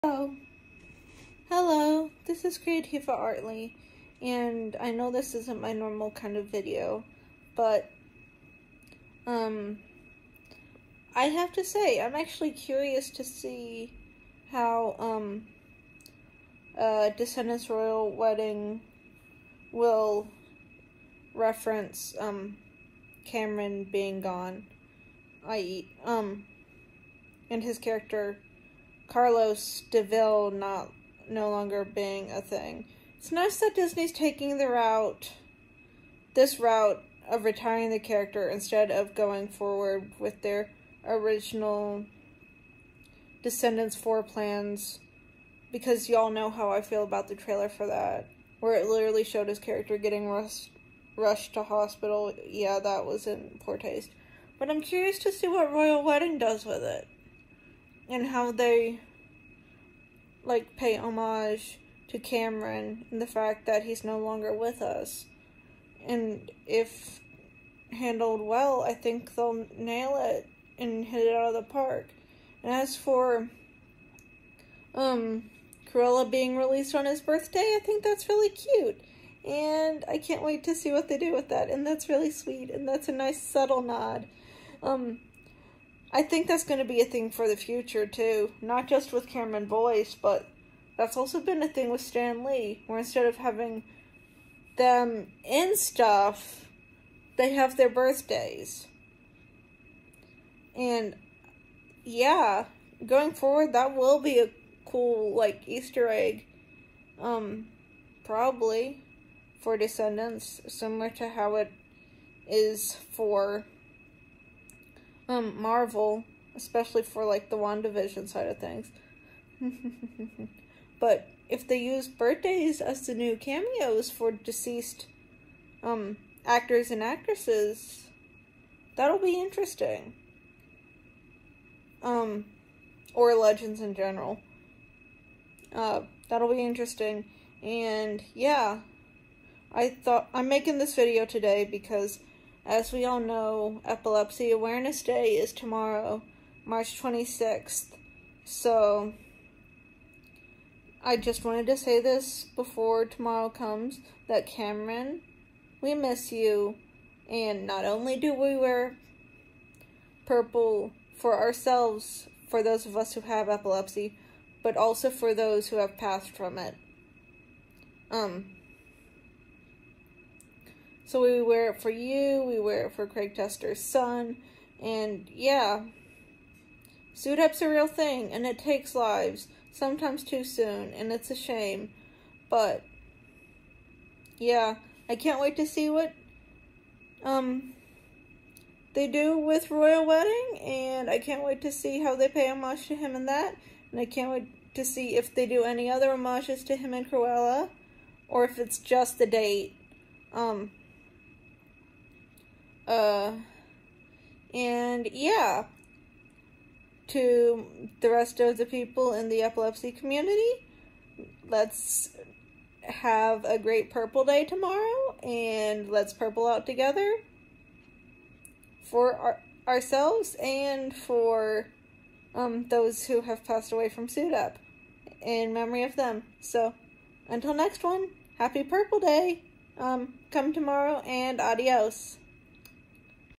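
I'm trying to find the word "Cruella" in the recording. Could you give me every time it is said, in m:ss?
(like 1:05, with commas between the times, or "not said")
1:15, 3:17.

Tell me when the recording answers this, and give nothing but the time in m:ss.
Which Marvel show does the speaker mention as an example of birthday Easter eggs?
1:57.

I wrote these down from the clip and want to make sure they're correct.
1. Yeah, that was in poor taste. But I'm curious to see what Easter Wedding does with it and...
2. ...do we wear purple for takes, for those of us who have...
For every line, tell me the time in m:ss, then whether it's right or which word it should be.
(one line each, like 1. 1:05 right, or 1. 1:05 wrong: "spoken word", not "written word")
1. 0:52 wrong: "Royal", not "Easter"
2. 2:38 wrong: "ourselves", not "takes".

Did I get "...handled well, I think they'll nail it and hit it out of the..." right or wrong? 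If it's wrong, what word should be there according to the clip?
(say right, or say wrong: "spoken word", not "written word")
right.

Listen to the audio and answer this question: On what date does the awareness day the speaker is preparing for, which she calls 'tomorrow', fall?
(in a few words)
March 26.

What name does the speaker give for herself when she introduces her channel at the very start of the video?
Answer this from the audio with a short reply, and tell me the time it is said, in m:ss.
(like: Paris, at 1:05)
Creativa Artly, at 0:02.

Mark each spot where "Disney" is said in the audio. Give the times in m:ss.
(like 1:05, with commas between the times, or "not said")
0:33.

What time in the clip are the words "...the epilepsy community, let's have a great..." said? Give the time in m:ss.
3:29.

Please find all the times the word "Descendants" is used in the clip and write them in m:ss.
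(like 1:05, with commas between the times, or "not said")
0:17, 0:43, 1:49.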